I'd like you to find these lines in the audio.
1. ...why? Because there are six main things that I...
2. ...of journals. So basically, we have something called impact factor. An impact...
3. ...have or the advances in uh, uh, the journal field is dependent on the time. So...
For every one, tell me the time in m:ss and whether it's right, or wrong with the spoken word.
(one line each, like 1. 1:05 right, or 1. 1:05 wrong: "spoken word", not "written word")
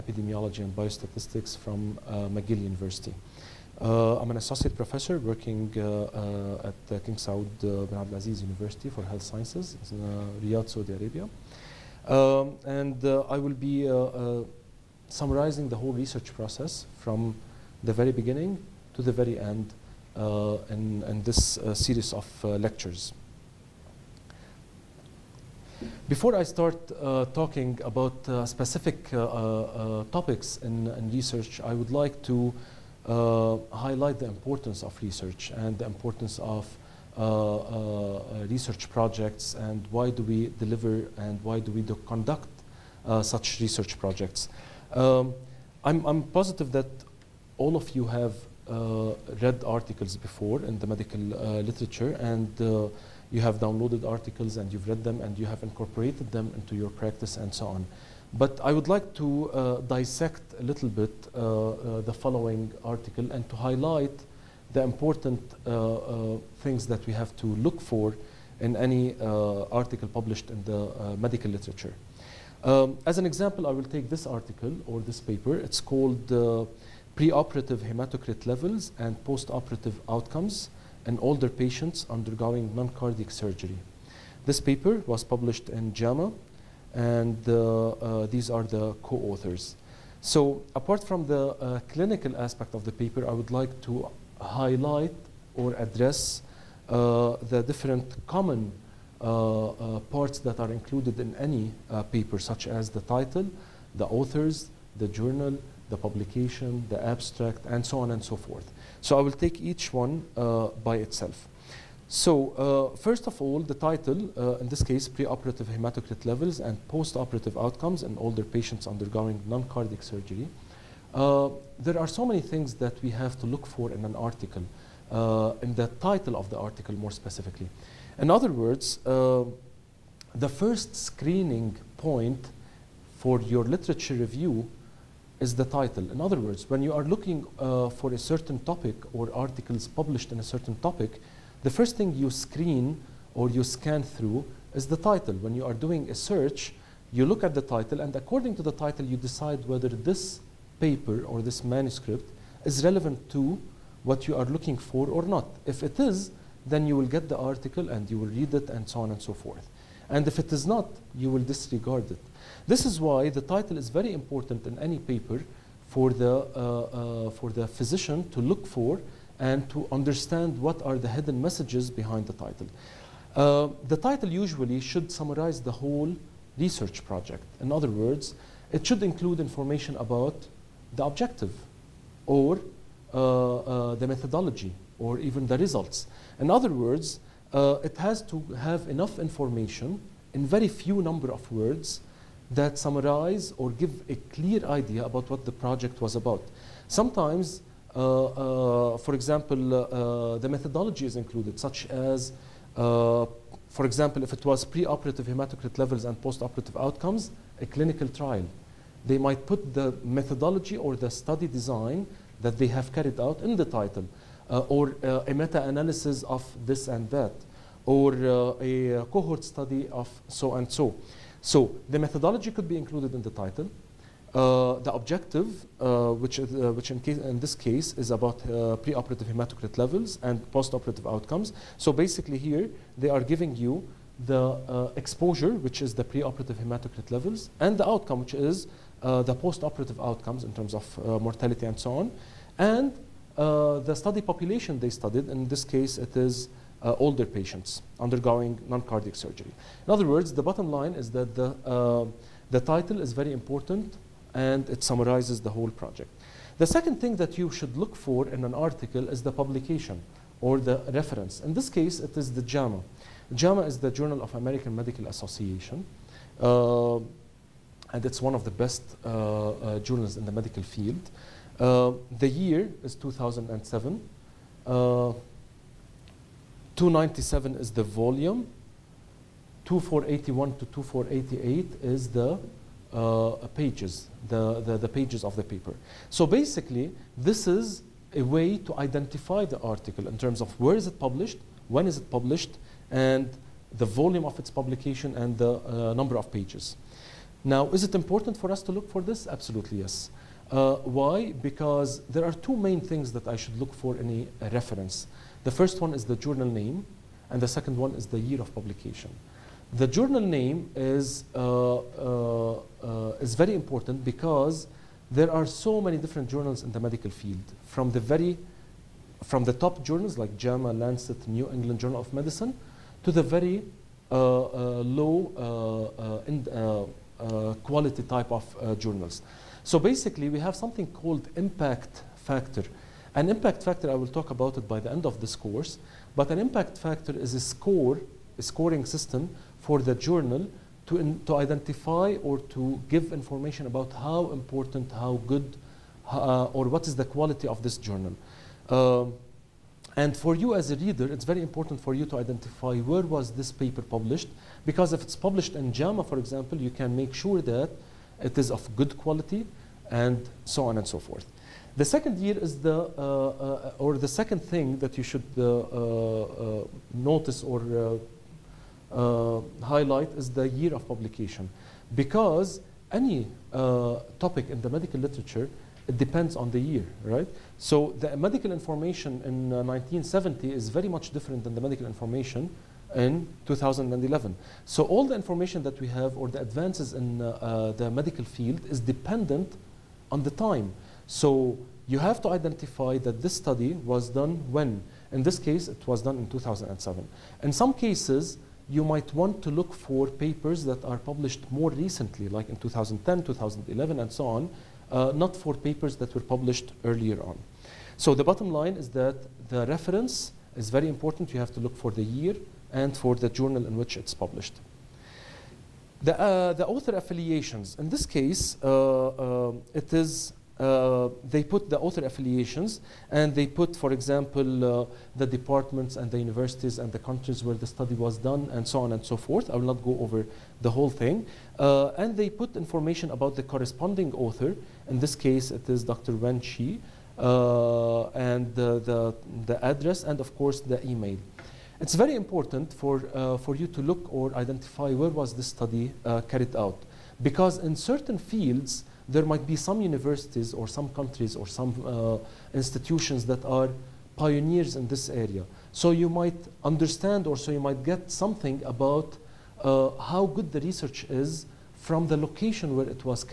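1. 5:00 wrong: "two", not "six"
2. 5:28 right
3. 6:25 wrong: "medical", not "journal".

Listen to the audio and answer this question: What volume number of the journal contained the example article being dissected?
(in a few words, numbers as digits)
297.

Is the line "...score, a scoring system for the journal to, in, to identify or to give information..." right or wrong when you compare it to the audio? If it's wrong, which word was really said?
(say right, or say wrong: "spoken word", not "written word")
right.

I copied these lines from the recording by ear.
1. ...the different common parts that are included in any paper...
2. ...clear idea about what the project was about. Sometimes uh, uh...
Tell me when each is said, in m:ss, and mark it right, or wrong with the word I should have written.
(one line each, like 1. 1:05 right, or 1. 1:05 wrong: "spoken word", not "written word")
1. 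1:37 right
2. 3:14 right.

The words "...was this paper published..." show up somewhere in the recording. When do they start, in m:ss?
5:53.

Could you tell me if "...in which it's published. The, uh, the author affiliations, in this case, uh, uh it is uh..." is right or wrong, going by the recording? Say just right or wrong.
right.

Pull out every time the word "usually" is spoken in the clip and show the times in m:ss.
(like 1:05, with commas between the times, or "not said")
2:54.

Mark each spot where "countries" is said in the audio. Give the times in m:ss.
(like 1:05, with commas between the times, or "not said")
7:06, 7:30.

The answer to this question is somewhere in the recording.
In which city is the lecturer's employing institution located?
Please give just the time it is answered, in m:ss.
0:10.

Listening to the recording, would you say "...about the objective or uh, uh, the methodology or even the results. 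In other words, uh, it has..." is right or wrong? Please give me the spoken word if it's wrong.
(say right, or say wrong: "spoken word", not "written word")
right.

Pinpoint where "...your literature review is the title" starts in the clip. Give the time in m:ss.
2:13.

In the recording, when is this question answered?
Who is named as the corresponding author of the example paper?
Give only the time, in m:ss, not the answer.
7:15.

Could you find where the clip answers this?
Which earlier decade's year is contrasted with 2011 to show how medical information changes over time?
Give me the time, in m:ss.
6:19.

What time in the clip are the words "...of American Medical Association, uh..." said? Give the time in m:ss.
4:24.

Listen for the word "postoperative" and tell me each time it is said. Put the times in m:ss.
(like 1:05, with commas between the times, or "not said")
1:19, 1:56, 3:26, 3:50, 3:59.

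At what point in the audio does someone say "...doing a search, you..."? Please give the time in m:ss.
2:25.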